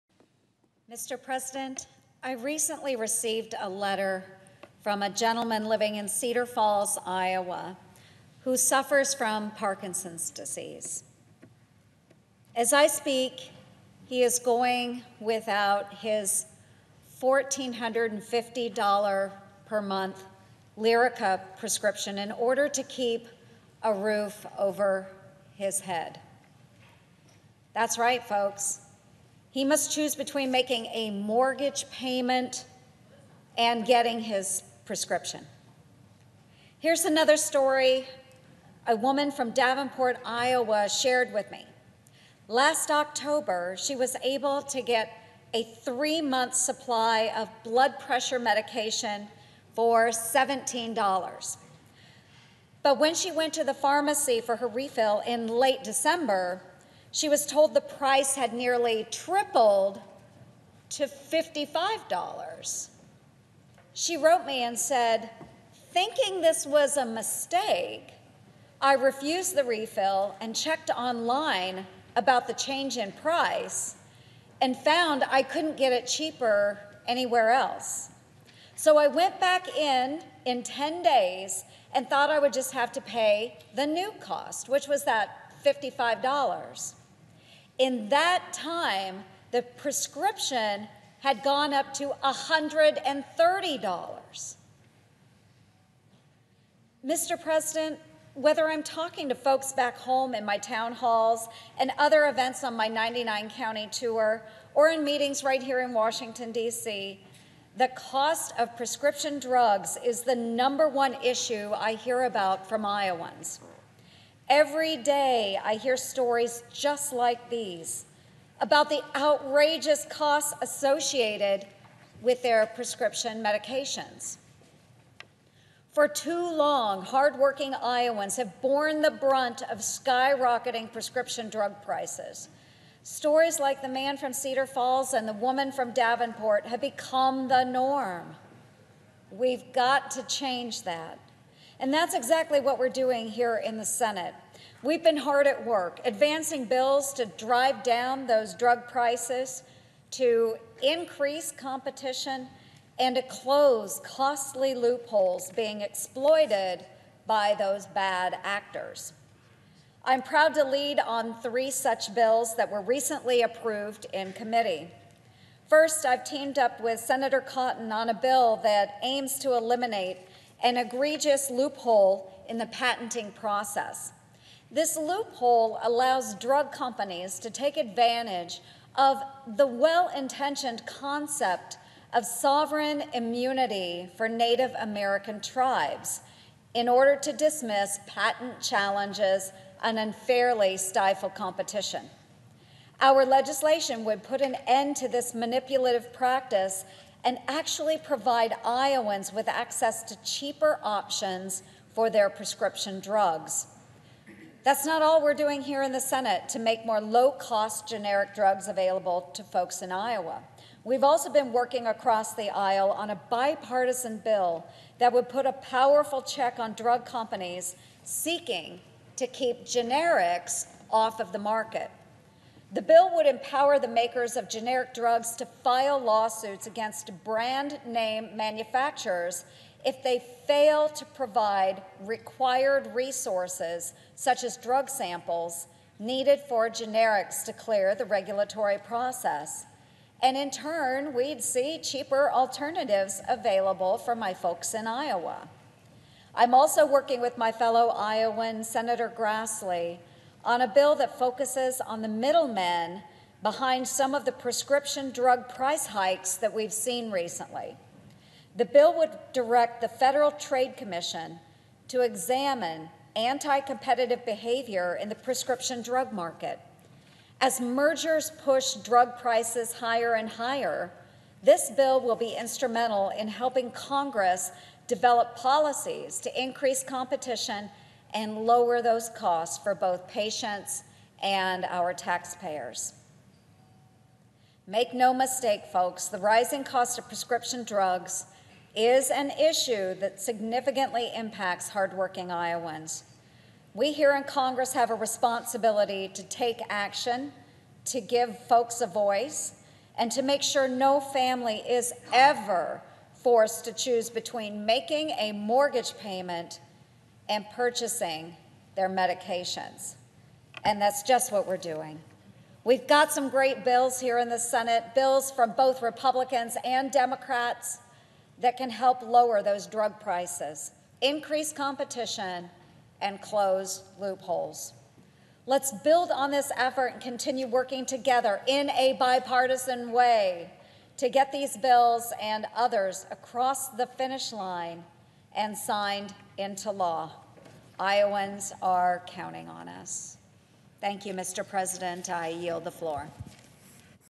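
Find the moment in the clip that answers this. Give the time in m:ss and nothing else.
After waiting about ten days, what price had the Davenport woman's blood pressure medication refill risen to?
1:32.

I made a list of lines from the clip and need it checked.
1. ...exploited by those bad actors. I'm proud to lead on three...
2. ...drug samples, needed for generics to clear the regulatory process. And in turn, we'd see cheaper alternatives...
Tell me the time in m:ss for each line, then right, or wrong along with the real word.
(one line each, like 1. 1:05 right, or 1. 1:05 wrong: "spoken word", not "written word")
1. 2:35 right
2. 3:54 right.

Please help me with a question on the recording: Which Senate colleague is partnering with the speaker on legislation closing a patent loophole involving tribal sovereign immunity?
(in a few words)
Senator Cotton.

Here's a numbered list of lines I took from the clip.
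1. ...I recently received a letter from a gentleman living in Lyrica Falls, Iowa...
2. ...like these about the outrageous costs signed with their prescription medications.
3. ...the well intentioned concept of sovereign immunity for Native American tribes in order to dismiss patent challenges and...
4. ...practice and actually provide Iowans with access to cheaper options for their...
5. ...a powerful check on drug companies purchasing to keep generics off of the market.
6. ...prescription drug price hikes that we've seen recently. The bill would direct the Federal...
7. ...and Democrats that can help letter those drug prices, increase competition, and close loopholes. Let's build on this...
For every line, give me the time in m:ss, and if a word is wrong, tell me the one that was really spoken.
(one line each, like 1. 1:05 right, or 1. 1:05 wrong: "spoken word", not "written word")
1. 0:02 wrong: "Cedar", not "Lyrica"
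2. 1:57 wrong: "associated", not "signed"
3. 2:59 right
4. 3:16 right
5. 3:35 wrong: "seeking", not "purchasing"
6. 4:14 right
7. 5:16 wrong: "lower", not "letter".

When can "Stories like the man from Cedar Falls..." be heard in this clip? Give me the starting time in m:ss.
2:13.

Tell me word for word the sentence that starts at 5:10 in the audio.
And that's just what we're doing.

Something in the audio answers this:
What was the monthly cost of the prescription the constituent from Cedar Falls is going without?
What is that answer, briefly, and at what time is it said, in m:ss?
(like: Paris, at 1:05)
$1,450, at 0:17.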